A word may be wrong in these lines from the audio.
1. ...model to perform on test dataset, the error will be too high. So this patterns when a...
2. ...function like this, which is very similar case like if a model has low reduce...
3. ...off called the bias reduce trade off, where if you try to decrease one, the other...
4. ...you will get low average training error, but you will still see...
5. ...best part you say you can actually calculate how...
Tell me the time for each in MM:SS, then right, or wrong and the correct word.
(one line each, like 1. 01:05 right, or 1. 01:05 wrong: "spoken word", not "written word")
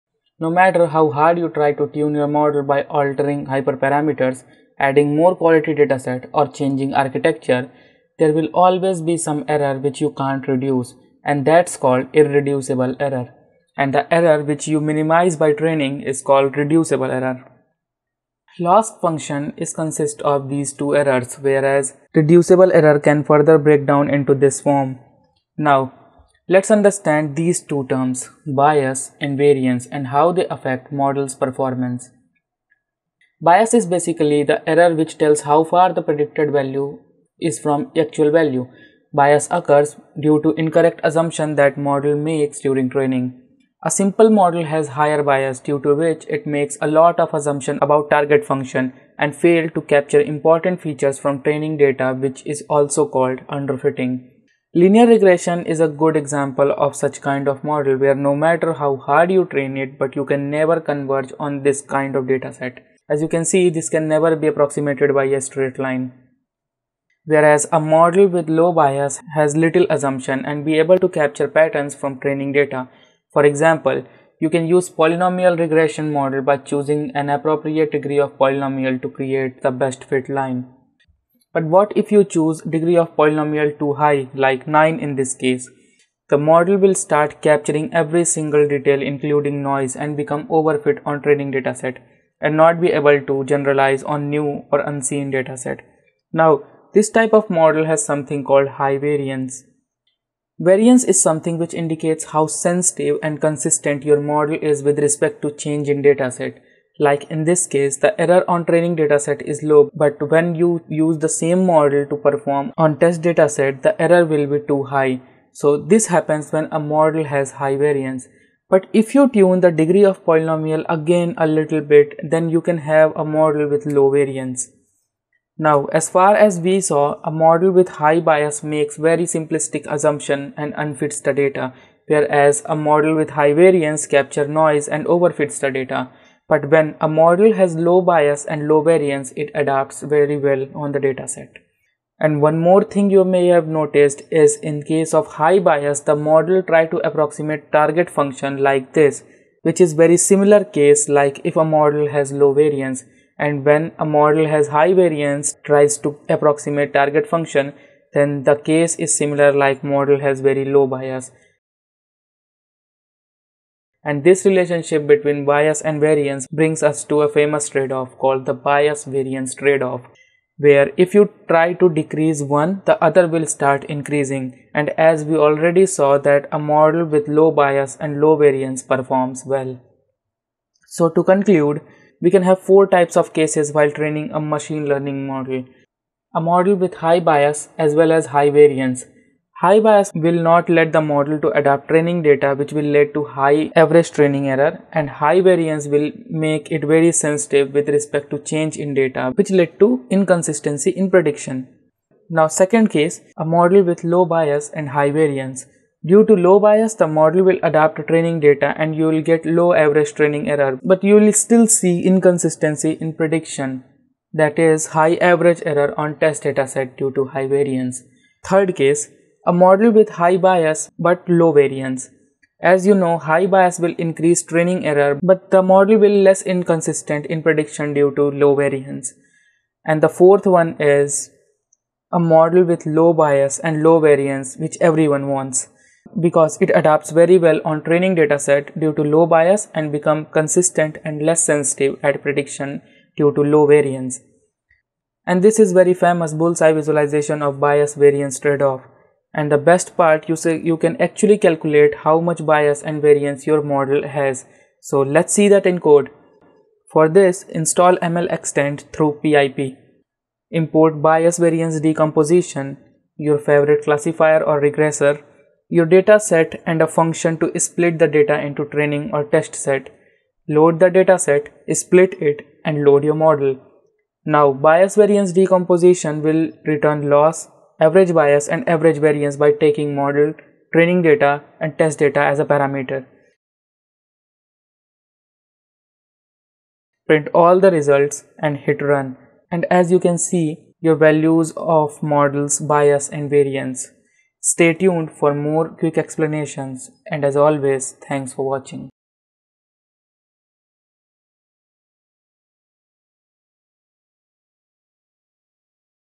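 1. 01:51 wrong: "happens", not "patterns"
2. 02:28 wrong: "variance", not "reduce"
3. 02:47 wrong: "variance", not "reduce"
4. 03:28 right
5. 04:09 right.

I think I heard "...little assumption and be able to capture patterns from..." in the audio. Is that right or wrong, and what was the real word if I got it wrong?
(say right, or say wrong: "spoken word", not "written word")
right.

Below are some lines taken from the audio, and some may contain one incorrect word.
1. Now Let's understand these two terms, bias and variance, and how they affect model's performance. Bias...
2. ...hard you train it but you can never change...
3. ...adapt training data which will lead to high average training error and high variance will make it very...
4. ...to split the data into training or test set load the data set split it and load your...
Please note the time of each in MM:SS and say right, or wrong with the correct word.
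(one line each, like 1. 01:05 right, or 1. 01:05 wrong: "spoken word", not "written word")
1. 00:25 right
2. 00:58 wrong: "converge", not "change"
3. 03:11 right
4. 04:27 right.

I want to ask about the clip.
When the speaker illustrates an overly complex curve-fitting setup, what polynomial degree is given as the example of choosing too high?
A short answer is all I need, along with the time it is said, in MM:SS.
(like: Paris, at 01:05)
9, at 01:24.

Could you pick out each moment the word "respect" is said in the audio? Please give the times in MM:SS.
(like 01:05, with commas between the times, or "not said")
01:44, 03:17.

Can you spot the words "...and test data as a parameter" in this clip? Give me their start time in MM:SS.
04:41.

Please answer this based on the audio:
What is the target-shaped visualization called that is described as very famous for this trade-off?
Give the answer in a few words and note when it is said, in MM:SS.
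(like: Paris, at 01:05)
Bullseye visualization, at 04:06.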